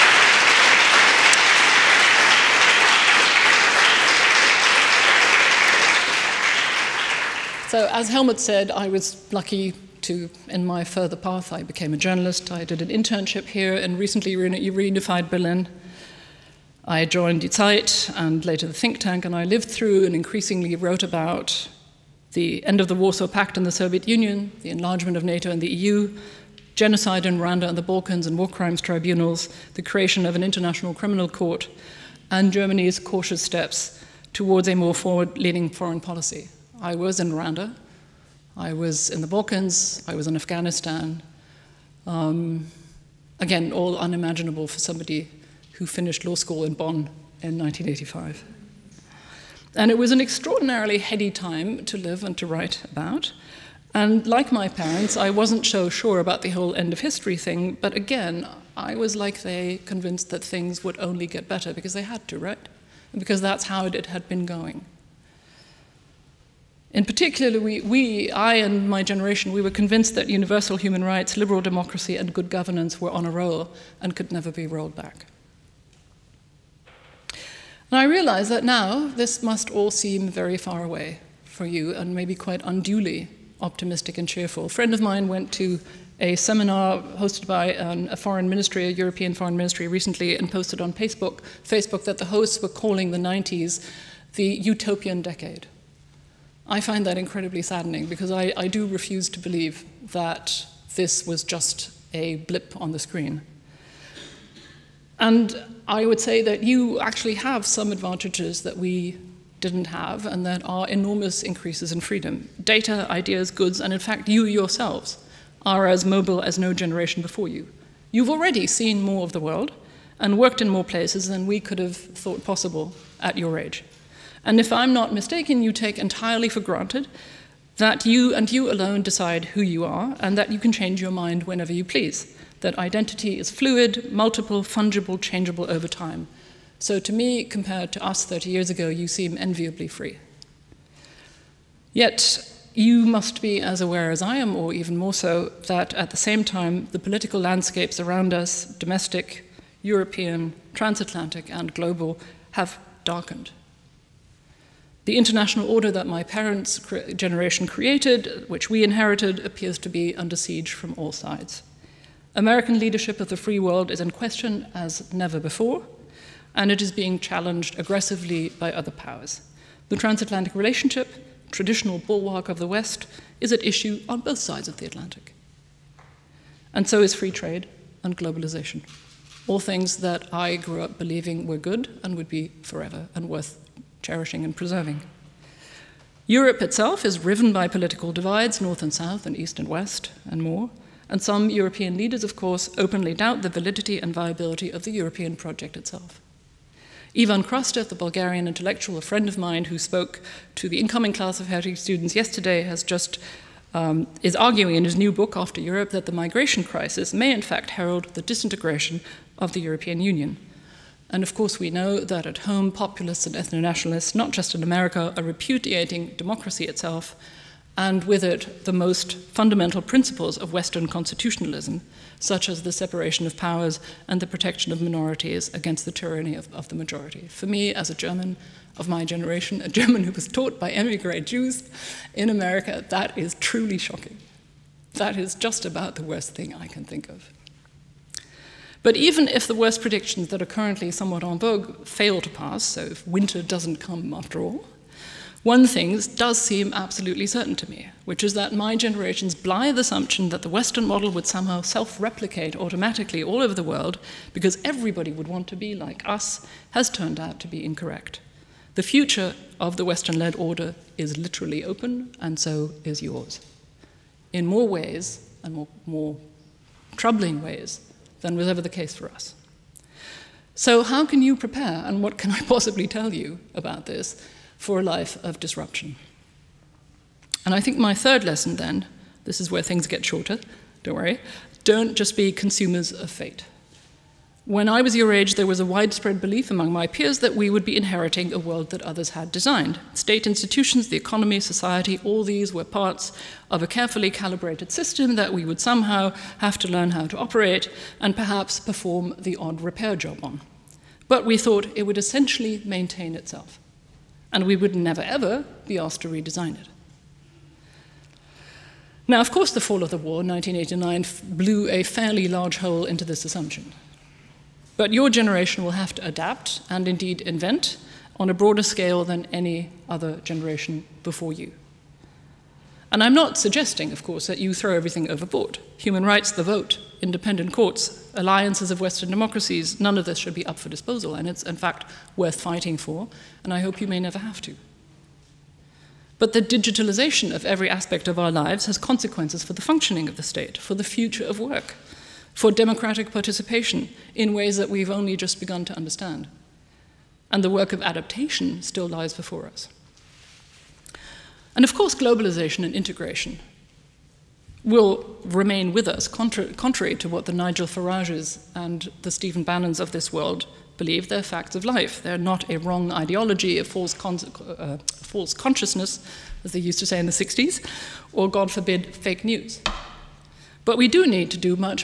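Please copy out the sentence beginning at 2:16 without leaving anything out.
So to me, compared to us 30 years ago, you seem enviably free.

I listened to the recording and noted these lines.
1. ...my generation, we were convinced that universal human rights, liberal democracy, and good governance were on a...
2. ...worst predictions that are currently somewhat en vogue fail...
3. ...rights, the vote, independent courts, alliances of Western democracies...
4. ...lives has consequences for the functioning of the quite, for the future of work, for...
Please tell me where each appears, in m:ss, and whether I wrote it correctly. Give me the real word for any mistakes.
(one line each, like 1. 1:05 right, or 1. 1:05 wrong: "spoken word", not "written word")
1. 1:08 right
2. 3:59 right
3. 5:26 right
4. 5:38 wrong: "state", not "quite".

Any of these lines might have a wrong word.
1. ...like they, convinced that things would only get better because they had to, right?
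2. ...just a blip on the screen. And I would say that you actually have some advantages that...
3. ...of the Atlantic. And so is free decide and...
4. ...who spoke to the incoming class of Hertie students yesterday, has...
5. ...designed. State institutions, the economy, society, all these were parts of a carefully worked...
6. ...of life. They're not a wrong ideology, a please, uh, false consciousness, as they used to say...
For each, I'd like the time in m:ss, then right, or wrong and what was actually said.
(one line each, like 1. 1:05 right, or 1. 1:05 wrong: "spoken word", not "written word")
1. 0:59 right
2. 1:41 right
3. 2:54 wrong: "trade", not "decide"
4. 3:19 right
5. 4:49 wrong: "calibrated", not "worked"
6. 6:01 wrong: "false", not "please".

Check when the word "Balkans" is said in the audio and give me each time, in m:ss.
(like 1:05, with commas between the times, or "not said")
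0:27, 0:39.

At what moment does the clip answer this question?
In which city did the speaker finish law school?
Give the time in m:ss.
0:46.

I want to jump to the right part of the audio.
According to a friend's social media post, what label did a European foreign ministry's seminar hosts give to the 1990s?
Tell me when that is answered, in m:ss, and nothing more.
1:34.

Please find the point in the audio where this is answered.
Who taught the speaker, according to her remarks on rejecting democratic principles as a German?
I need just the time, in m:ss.
3:50.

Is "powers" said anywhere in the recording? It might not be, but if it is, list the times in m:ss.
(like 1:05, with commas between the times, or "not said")
2:48, 3:43.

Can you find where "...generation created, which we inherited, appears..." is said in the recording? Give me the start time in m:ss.
2:37.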